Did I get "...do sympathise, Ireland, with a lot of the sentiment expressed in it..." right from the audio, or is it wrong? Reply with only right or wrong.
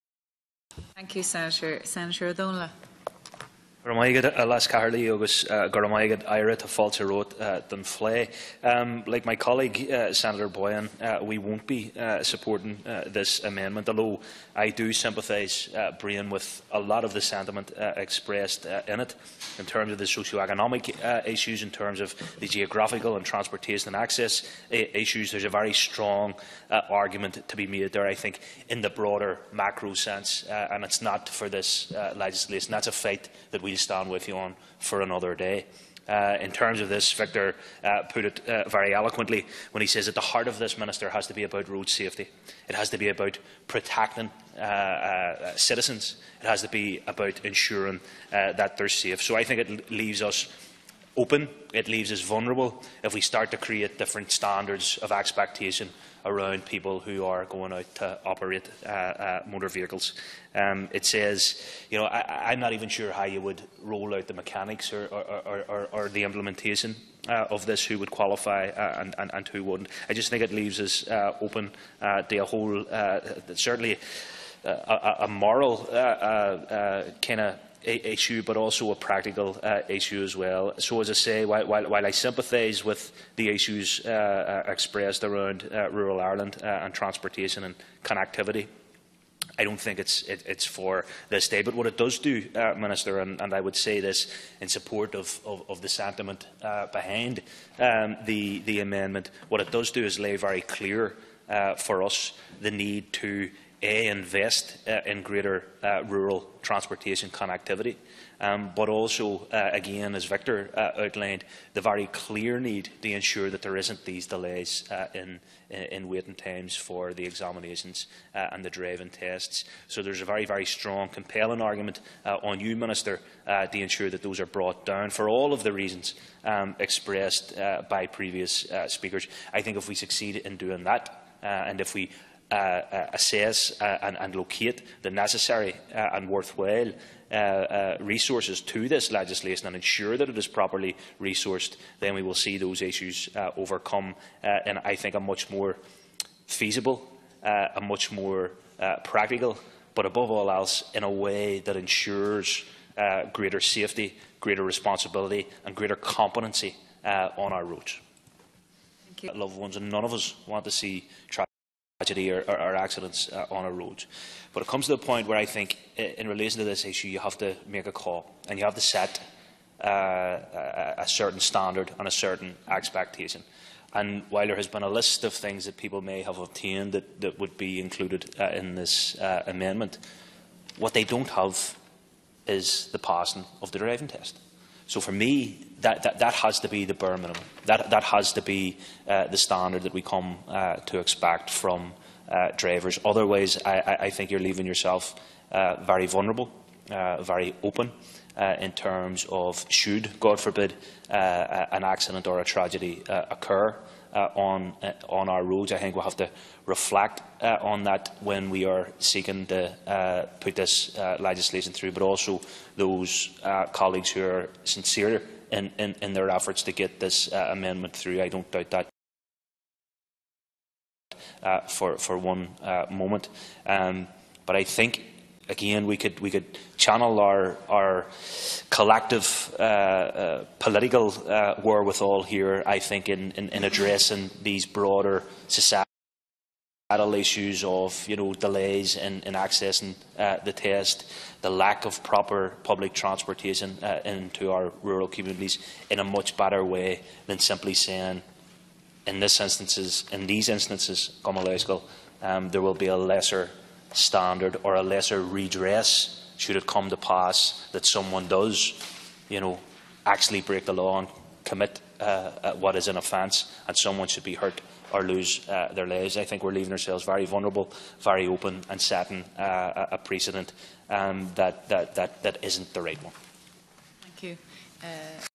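wrong.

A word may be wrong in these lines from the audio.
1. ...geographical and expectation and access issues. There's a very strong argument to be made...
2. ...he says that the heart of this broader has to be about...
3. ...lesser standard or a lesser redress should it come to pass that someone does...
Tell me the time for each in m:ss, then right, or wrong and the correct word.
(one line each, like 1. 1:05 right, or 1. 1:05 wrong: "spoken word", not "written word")
1. 0:22 wrong: "transportation", not "expectation"
2. 0:39 wrong: "minister", not "broader"
3. 4:12 right.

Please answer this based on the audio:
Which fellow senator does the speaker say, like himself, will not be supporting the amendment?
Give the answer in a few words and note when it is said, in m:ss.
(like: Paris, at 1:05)
Senator Boyhan, at 0:10.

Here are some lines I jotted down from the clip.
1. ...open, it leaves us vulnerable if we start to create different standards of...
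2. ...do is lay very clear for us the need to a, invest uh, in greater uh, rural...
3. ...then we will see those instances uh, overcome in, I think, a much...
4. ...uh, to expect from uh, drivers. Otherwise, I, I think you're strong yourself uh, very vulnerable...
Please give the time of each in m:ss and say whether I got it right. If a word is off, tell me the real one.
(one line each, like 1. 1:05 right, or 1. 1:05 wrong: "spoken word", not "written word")
1. 0:51 right
2. 1:39 right
3. 2:22 wrong: "issues", not "instances"
4. 3:10 wrong: "leaving", not "strong".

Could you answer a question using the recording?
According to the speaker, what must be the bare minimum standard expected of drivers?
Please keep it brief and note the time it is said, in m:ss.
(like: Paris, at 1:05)
passing of the driving test, at 3:02.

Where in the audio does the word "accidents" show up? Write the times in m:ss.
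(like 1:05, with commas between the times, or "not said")
2:42, 3:21.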